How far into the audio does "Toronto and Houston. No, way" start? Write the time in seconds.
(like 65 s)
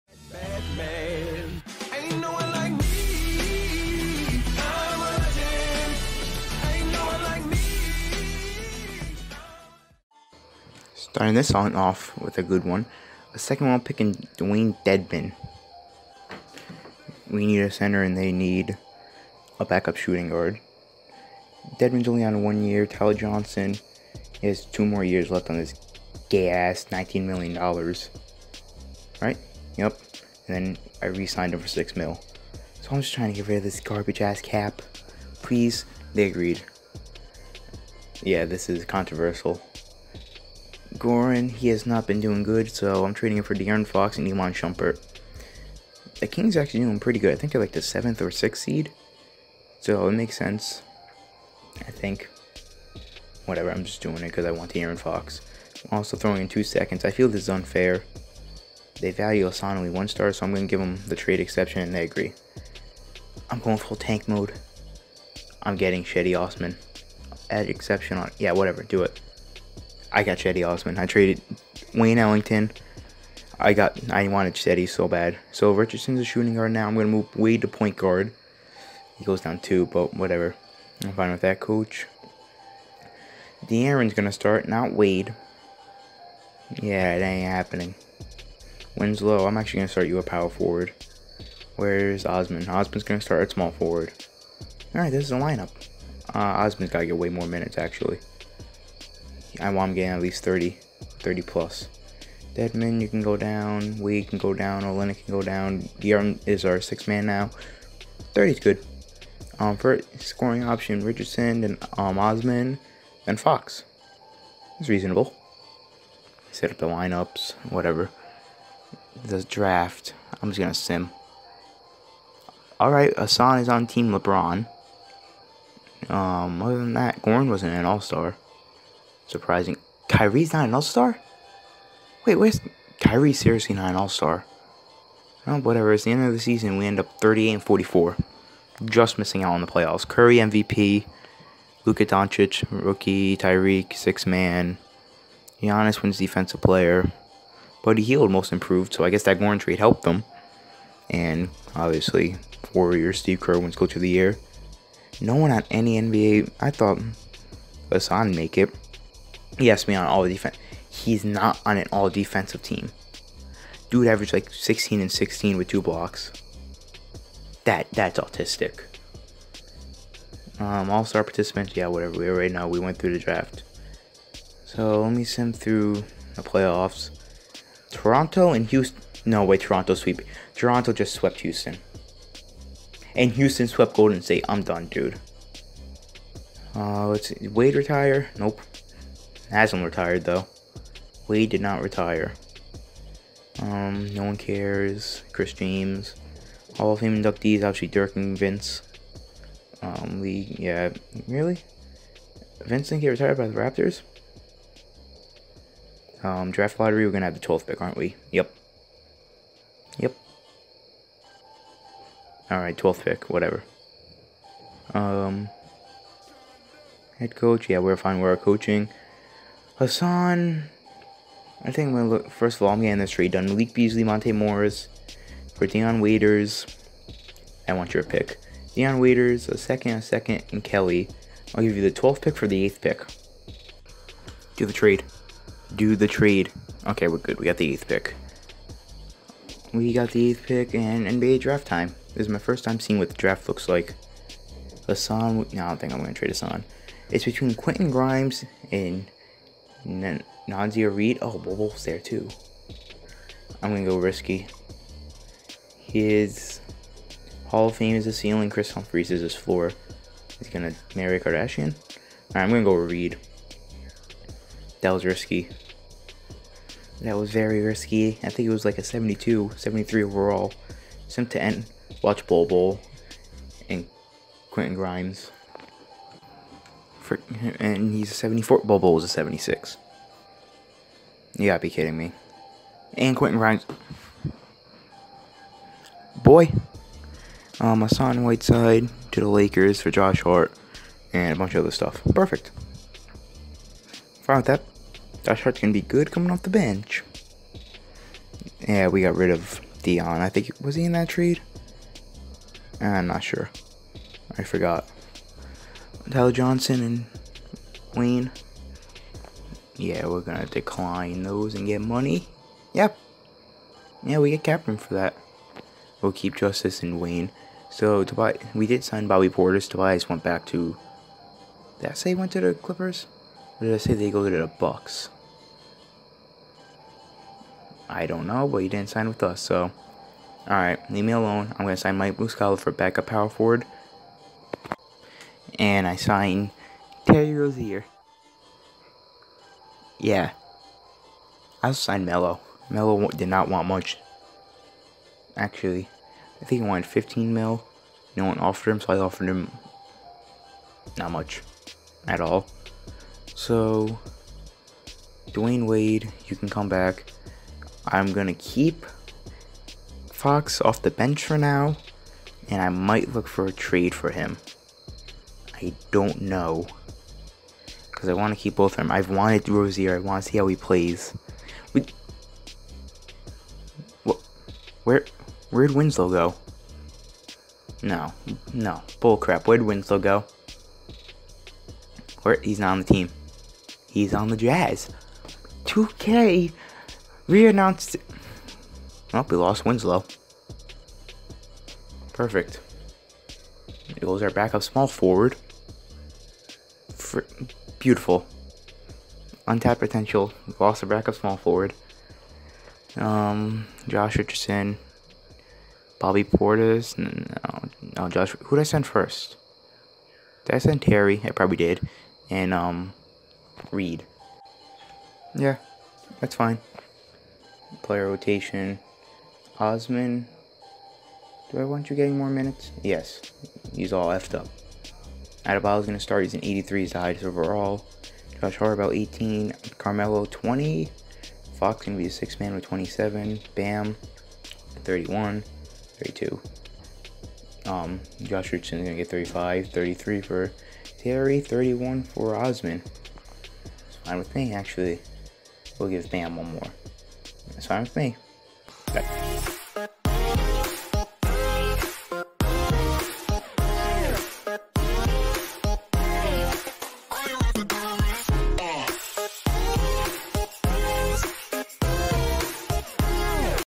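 177 s.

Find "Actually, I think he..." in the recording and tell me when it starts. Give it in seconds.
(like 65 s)
345 s.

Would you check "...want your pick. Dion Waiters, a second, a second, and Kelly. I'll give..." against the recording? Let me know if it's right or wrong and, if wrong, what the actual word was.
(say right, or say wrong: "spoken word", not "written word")
right.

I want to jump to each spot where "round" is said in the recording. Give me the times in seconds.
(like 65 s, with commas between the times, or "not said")
13 s.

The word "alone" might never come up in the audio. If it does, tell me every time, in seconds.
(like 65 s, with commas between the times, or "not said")
331 s.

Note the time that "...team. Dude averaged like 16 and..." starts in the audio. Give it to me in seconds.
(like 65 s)
162 s.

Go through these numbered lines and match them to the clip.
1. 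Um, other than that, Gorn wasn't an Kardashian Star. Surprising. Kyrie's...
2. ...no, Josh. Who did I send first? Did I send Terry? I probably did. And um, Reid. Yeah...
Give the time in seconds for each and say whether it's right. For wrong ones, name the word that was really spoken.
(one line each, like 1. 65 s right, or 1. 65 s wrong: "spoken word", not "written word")
1. 126 s wrong: "All", not "Kardashian"
2. 407 s right.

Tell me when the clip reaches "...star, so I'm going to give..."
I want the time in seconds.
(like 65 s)
60 s.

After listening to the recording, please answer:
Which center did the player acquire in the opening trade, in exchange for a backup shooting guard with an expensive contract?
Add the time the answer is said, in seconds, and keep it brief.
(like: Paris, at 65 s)
Dewayne Dedmon, at 14 s.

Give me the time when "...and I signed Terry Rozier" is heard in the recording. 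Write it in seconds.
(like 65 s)
335 s.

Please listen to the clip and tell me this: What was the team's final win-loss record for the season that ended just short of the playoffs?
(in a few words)
38 and 44.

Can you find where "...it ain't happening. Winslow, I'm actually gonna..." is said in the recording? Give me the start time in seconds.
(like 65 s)
87 s.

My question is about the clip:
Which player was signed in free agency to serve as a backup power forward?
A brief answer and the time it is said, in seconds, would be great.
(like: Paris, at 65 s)
Mike Muscala, at 331 s.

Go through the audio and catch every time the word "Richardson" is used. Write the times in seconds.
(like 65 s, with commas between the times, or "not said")
75 s, 111 s, 404 s, 438 s.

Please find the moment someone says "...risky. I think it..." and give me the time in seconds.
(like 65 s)
267 s.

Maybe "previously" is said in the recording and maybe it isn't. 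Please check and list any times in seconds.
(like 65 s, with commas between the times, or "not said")
not said.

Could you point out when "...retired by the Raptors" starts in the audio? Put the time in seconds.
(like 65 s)
203 s.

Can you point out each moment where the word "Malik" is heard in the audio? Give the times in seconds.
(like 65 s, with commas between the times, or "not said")
223 s.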